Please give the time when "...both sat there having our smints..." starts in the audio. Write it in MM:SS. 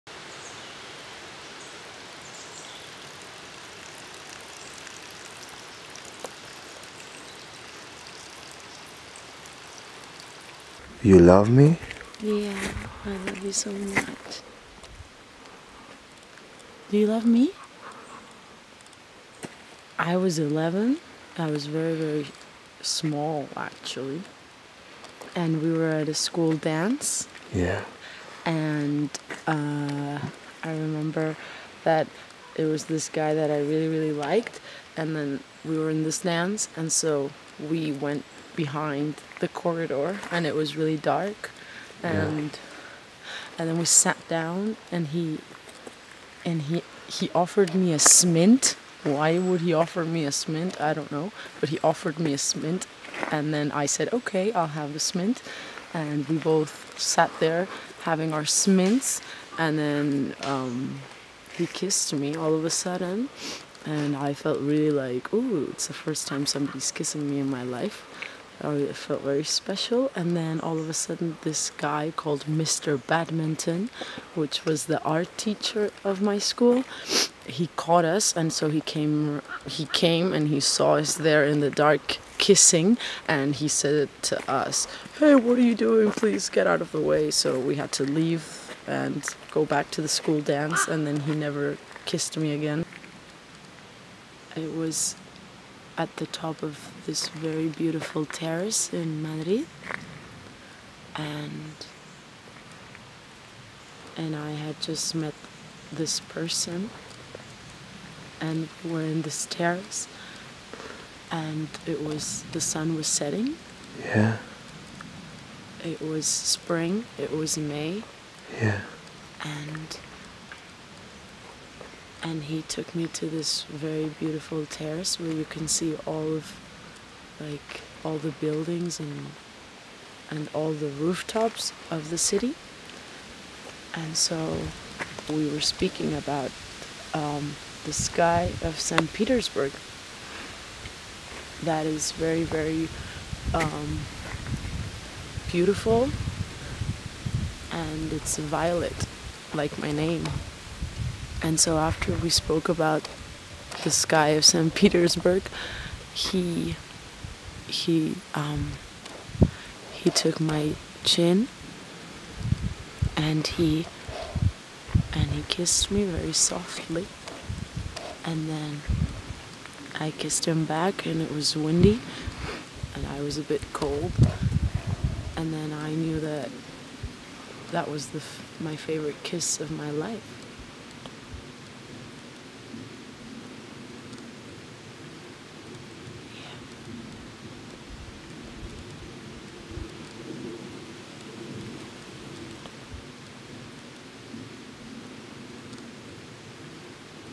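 00:56.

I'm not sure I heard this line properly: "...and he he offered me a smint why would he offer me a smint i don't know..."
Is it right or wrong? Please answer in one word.
right.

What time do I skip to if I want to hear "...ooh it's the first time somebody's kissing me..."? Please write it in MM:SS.
01:05.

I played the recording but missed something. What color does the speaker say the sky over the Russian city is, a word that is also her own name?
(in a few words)
violet.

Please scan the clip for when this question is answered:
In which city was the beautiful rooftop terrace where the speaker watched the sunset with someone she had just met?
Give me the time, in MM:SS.
01:39.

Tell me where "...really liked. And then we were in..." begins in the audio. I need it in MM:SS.
00:33.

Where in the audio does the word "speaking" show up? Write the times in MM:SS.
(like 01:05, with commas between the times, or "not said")
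02:15.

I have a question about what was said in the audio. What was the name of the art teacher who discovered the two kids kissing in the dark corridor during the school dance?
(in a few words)
Mr. Badminton.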